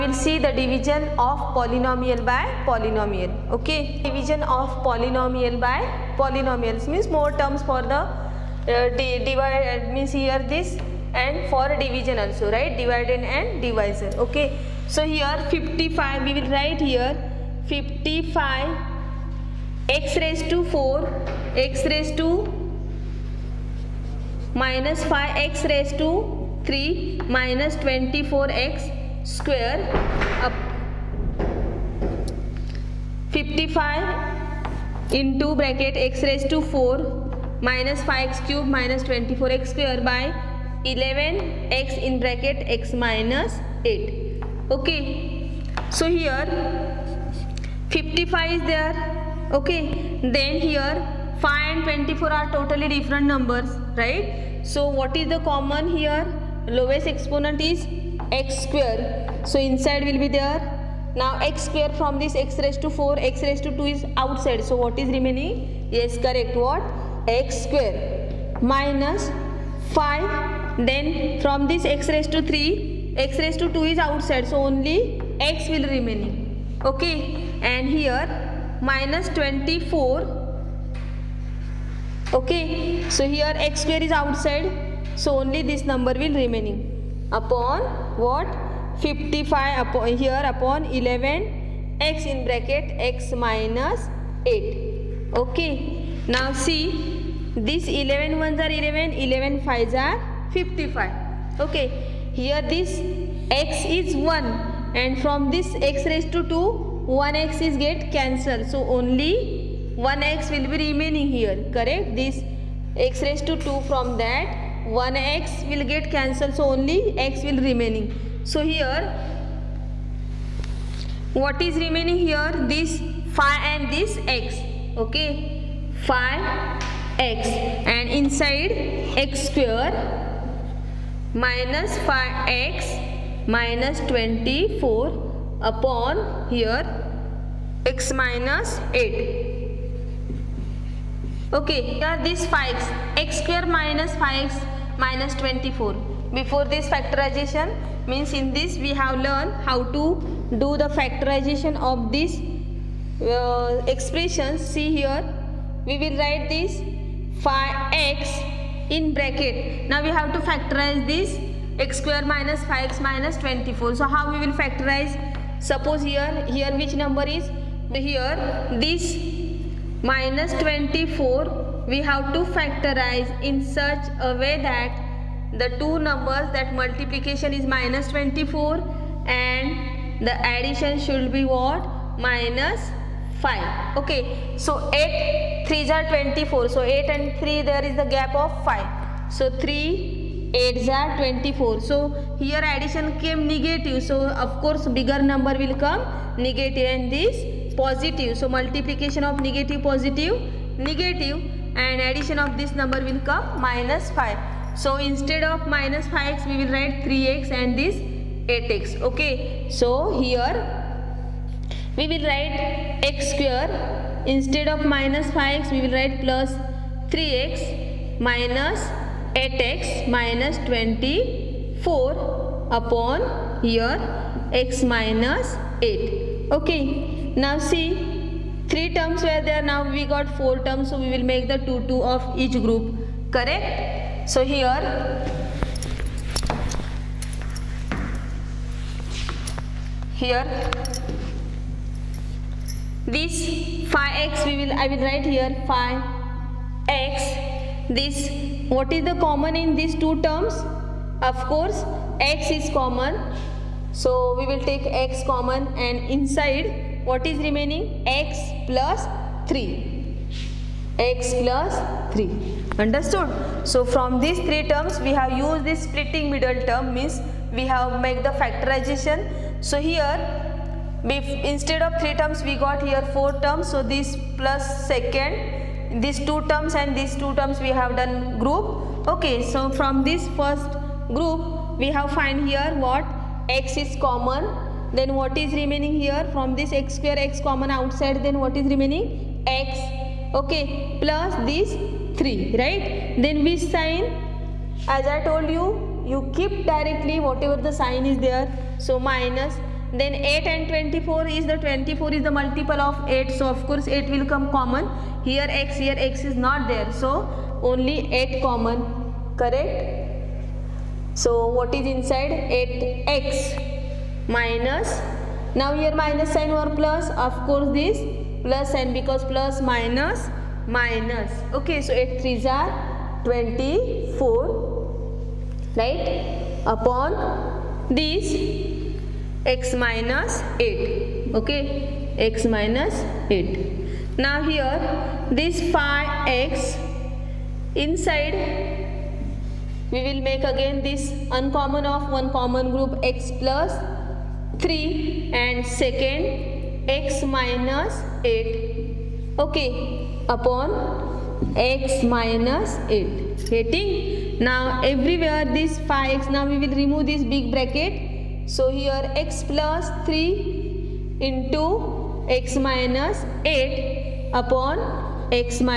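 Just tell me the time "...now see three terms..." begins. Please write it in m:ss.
3:47.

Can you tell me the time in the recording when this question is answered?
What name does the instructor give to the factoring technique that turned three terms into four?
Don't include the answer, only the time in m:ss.
4:25.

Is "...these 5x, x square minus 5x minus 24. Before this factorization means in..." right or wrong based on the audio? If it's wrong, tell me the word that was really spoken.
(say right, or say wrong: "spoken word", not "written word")
right.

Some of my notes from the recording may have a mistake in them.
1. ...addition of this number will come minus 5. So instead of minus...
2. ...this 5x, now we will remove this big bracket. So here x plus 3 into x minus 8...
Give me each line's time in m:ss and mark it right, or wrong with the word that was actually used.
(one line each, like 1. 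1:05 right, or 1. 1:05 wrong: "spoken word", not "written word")
1. 3:22 right
2. 5:55 right.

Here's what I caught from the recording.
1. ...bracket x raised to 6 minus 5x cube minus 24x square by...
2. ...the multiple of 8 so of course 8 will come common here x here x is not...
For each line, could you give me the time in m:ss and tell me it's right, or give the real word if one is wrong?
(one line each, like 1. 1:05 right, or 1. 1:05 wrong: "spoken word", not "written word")
1. 0:35 wrong: "4", not "6"
2. 5:02 right.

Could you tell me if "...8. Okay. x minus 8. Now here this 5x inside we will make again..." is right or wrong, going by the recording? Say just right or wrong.
right.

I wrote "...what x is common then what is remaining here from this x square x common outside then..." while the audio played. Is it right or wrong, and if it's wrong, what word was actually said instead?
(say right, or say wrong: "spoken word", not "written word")
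right.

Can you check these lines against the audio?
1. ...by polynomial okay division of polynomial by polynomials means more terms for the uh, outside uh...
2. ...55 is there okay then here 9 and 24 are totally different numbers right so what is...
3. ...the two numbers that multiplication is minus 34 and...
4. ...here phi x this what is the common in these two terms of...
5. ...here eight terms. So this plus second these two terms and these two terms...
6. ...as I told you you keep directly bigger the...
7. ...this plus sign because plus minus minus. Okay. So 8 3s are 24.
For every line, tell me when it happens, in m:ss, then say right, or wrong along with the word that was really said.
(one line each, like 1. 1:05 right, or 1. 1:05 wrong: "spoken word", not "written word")
1. 0:02 wrong: "divide", not "outside"
2. 0:47 wrong: "5", not "9"
3. 2:55 wrong: "24", not "34"
4. 4:05 right
5. 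4:32 wrong: "four", not "eight"
6. 4:54 wrong: "whatever", not "bigger"
7. 5:17 right.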